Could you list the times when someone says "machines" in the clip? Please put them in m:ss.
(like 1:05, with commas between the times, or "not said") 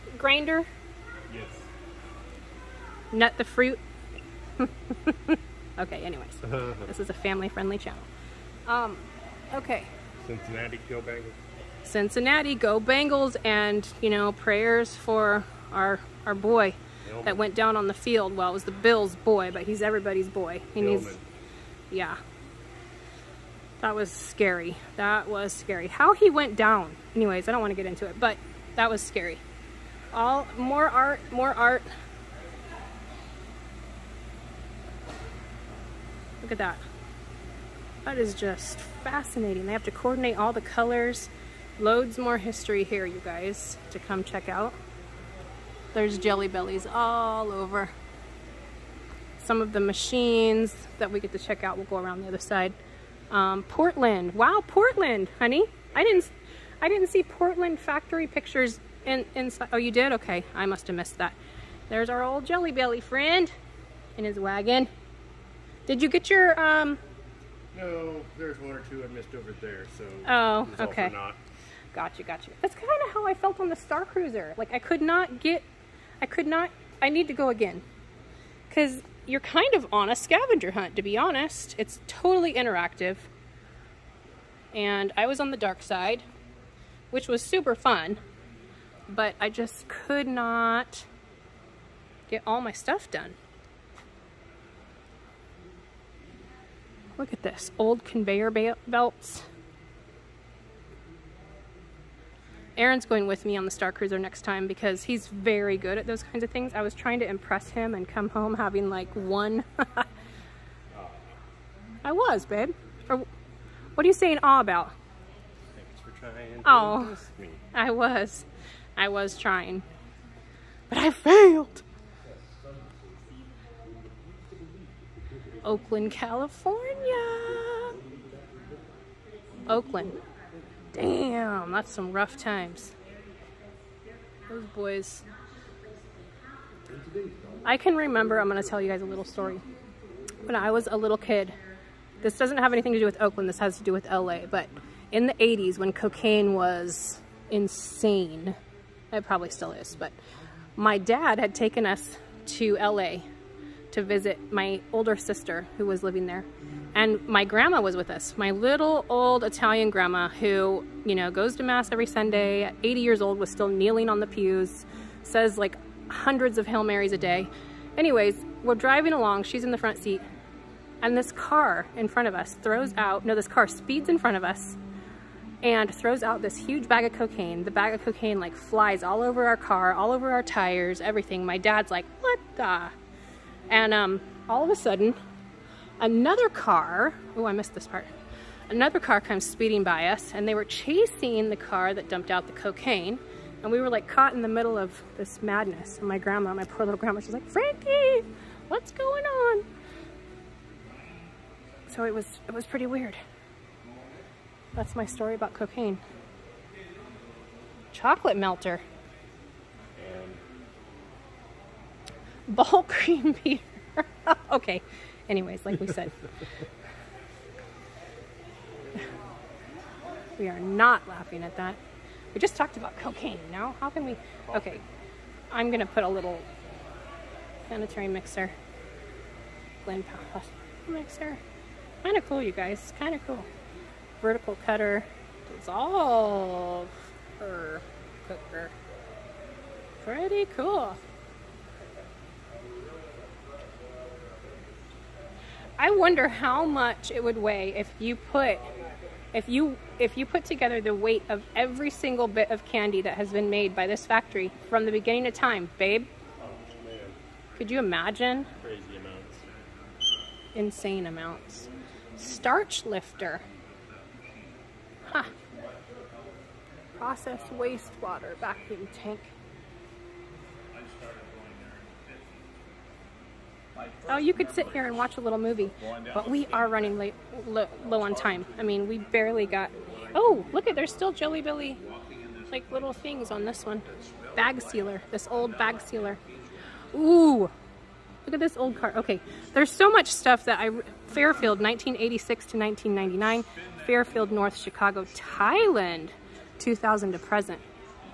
0:49.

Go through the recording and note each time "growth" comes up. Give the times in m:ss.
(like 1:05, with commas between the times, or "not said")
not said.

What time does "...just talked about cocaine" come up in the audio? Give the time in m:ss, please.
3:42.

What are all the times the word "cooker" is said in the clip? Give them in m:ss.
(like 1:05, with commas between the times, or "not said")
3:58.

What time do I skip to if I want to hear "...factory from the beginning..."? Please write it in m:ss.
4:14.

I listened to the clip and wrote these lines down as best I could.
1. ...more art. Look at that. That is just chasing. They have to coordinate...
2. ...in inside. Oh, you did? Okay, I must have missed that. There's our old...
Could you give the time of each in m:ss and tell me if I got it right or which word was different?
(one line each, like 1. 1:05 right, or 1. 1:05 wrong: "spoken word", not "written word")
1. 0:31 wrong: "fascinating", not "chasing"
2. 0:59 right.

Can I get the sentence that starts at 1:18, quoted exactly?
Because you're kind of on a scavenger hunt, to be honest.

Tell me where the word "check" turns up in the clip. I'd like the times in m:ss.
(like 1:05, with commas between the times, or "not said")
0:44, 0:51.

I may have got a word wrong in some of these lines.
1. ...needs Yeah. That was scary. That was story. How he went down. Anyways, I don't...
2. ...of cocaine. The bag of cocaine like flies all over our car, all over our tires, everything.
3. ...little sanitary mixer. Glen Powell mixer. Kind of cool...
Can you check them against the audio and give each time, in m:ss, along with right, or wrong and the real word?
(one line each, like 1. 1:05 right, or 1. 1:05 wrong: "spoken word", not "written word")
1. 0:20 wrong: "scary", not "story"
2. 2:57 right
3. 3:46 right.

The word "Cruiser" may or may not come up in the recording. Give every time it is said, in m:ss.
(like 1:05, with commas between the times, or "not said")
1:14, 1:43.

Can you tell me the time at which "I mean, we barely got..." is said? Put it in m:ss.
4:38.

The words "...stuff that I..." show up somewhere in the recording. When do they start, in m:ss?
4:50.